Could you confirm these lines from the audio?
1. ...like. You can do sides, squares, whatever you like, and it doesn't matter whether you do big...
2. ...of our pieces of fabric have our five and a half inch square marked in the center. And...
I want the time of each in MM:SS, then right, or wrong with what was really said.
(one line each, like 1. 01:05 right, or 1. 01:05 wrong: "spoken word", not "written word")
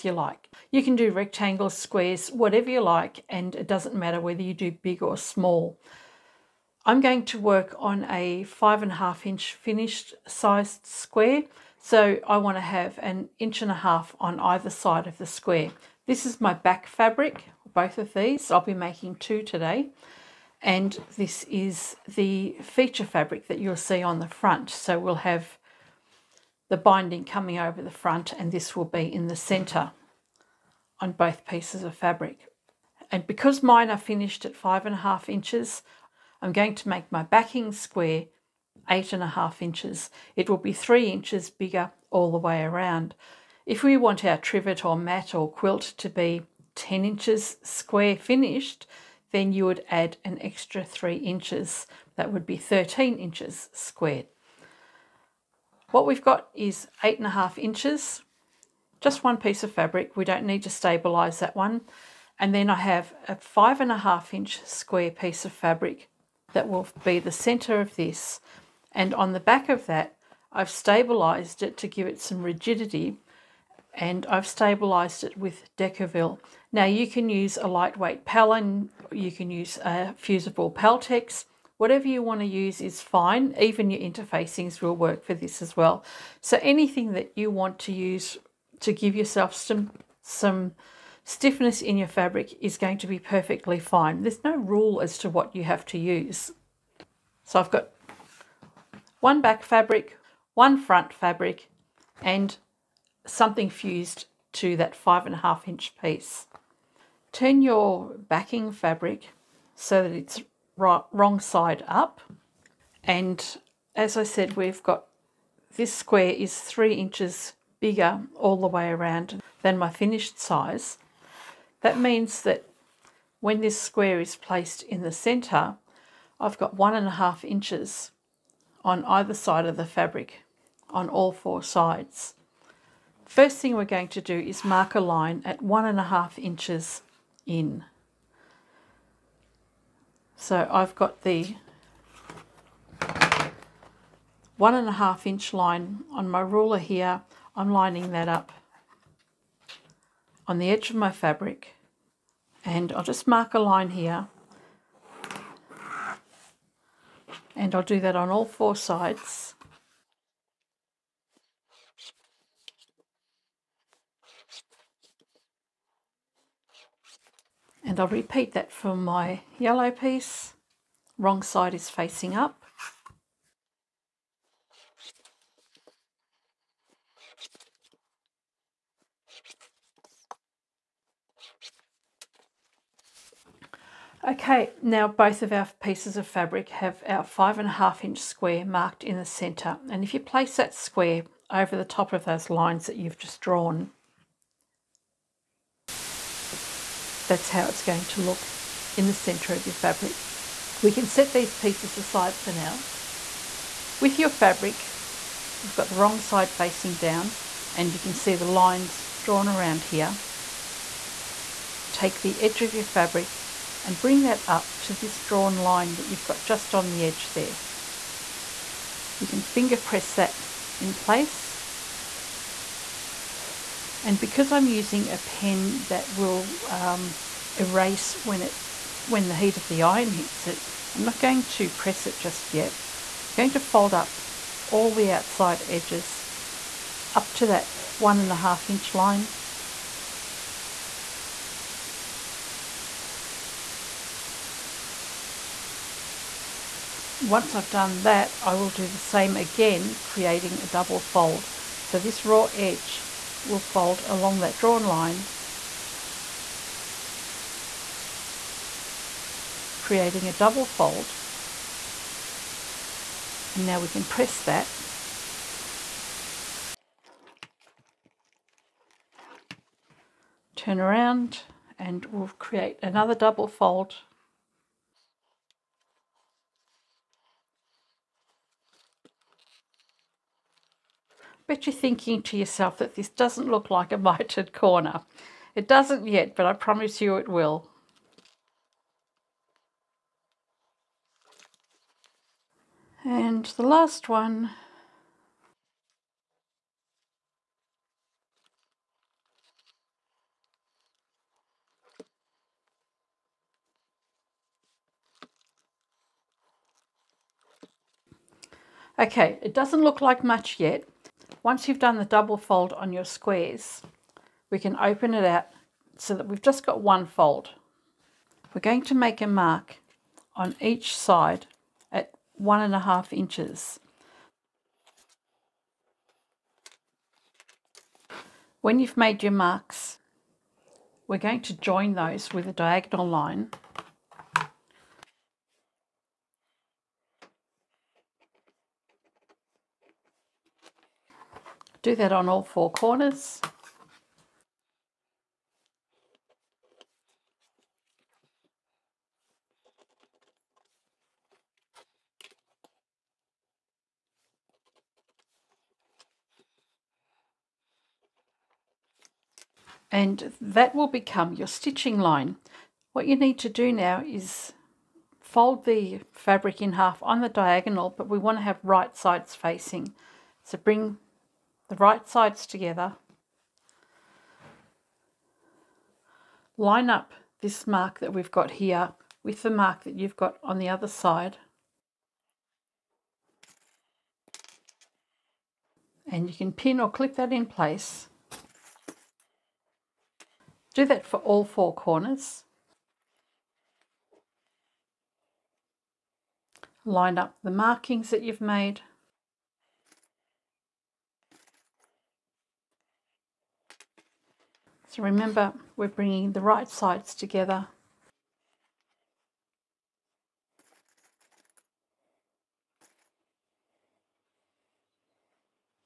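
1. 00:00 wrong: "rectangles", not "sides"
2. 03:05 right.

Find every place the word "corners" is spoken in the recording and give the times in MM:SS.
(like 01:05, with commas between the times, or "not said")
04:44, 05:42, 06:31.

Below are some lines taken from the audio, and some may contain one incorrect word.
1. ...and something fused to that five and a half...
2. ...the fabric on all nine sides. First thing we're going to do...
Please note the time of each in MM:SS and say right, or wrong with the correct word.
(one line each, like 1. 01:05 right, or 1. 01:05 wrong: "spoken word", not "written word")
1. 01:42 right
2. 02:09 wrong: "four", not "nine".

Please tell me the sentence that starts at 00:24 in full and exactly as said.
So we'll have the binding coming over the front and this will be in the centre on both pieces of fabric.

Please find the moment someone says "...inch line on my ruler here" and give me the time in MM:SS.
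02:25.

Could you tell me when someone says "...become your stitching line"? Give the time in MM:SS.
06:00.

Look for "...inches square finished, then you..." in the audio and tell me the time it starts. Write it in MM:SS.
00:47.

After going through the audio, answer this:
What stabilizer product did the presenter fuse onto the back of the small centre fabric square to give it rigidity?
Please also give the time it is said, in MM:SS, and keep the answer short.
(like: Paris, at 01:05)
Decovil, at 01:15.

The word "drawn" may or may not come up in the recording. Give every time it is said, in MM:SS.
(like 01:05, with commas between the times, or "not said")
03:13, 03:29, 03:35, 04:14.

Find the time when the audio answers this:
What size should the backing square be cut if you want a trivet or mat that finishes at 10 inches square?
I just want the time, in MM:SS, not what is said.
00:52.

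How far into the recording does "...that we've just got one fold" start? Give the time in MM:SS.
05:16.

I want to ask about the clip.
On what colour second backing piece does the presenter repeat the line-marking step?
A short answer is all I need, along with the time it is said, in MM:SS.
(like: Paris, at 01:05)
Yellow, at 02:49.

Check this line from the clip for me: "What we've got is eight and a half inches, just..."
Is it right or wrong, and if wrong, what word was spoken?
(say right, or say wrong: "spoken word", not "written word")
right.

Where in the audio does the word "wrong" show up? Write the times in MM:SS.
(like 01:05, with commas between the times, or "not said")
01:50, 02:51, 03:25.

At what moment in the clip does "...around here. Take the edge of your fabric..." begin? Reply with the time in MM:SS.
03:29.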